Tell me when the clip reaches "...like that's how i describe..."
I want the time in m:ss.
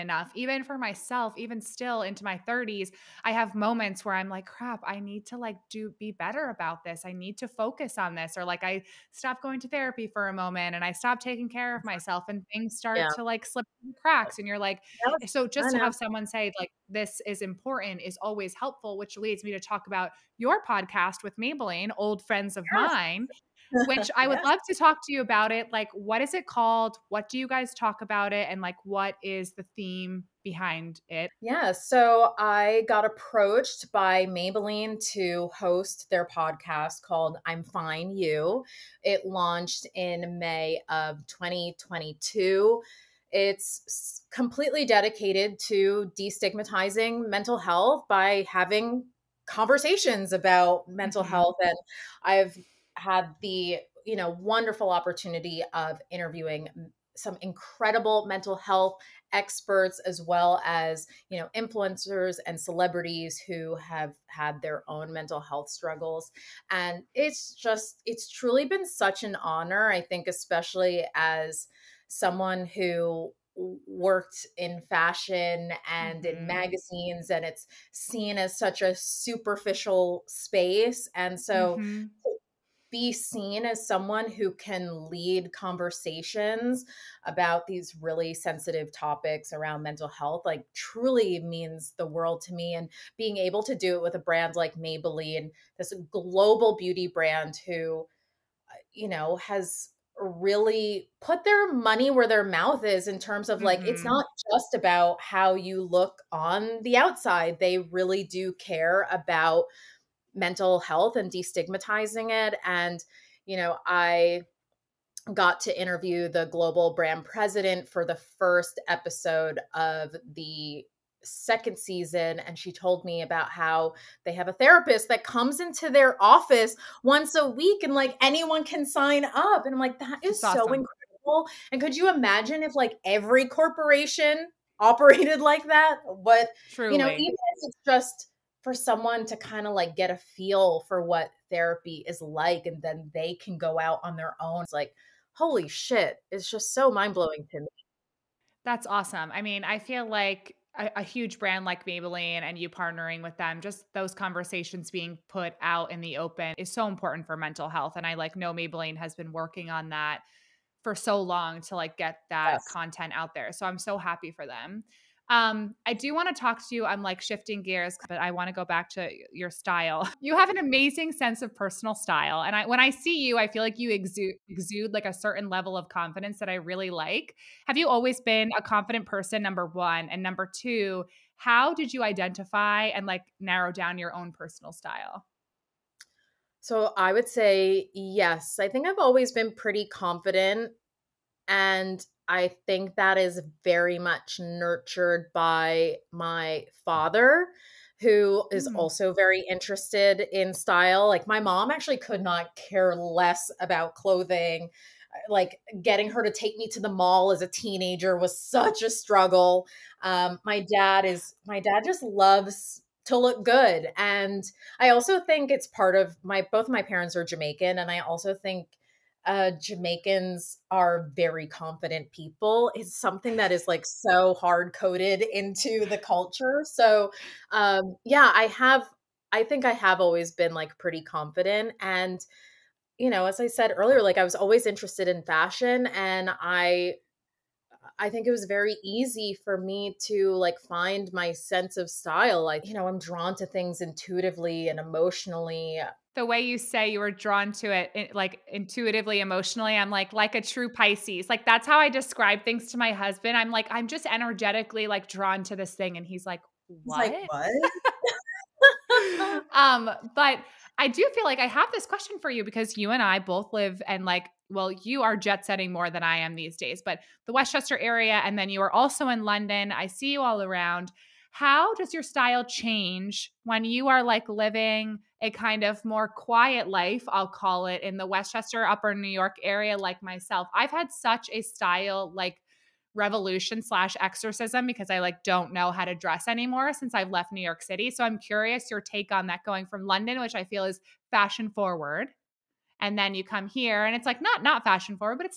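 4:11.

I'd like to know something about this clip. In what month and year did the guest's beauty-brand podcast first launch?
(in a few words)
May 2022.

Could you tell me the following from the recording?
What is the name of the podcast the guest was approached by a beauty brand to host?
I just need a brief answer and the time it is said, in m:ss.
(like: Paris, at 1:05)
I'm Fine You, at 0:37.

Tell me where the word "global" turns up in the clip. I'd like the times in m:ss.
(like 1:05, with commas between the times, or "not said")
1:36, 1:56.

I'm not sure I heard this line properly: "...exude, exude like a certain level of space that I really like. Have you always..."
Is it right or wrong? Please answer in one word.
wrong.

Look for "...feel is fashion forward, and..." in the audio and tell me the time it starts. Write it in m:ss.
4:50.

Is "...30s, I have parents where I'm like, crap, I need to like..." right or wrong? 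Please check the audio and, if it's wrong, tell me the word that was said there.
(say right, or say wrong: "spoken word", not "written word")
wrong: "moments", not "parents".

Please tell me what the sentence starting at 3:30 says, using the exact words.
Um, my dad is, my dad just loves to look good.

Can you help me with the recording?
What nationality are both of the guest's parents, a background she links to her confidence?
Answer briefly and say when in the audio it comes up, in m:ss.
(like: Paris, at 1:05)
Jamaican, at 3:37.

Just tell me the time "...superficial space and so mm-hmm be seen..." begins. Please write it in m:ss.
1:18.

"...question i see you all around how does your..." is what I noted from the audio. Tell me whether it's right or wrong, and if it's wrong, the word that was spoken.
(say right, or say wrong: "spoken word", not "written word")
wrong: "london", not "question".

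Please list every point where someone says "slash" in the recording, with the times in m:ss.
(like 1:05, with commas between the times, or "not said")
4:43.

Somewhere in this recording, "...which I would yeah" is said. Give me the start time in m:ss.
0:23.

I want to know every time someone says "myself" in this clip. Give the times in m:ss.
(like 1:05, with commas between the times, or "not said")
0:00, 0:11, 4:40.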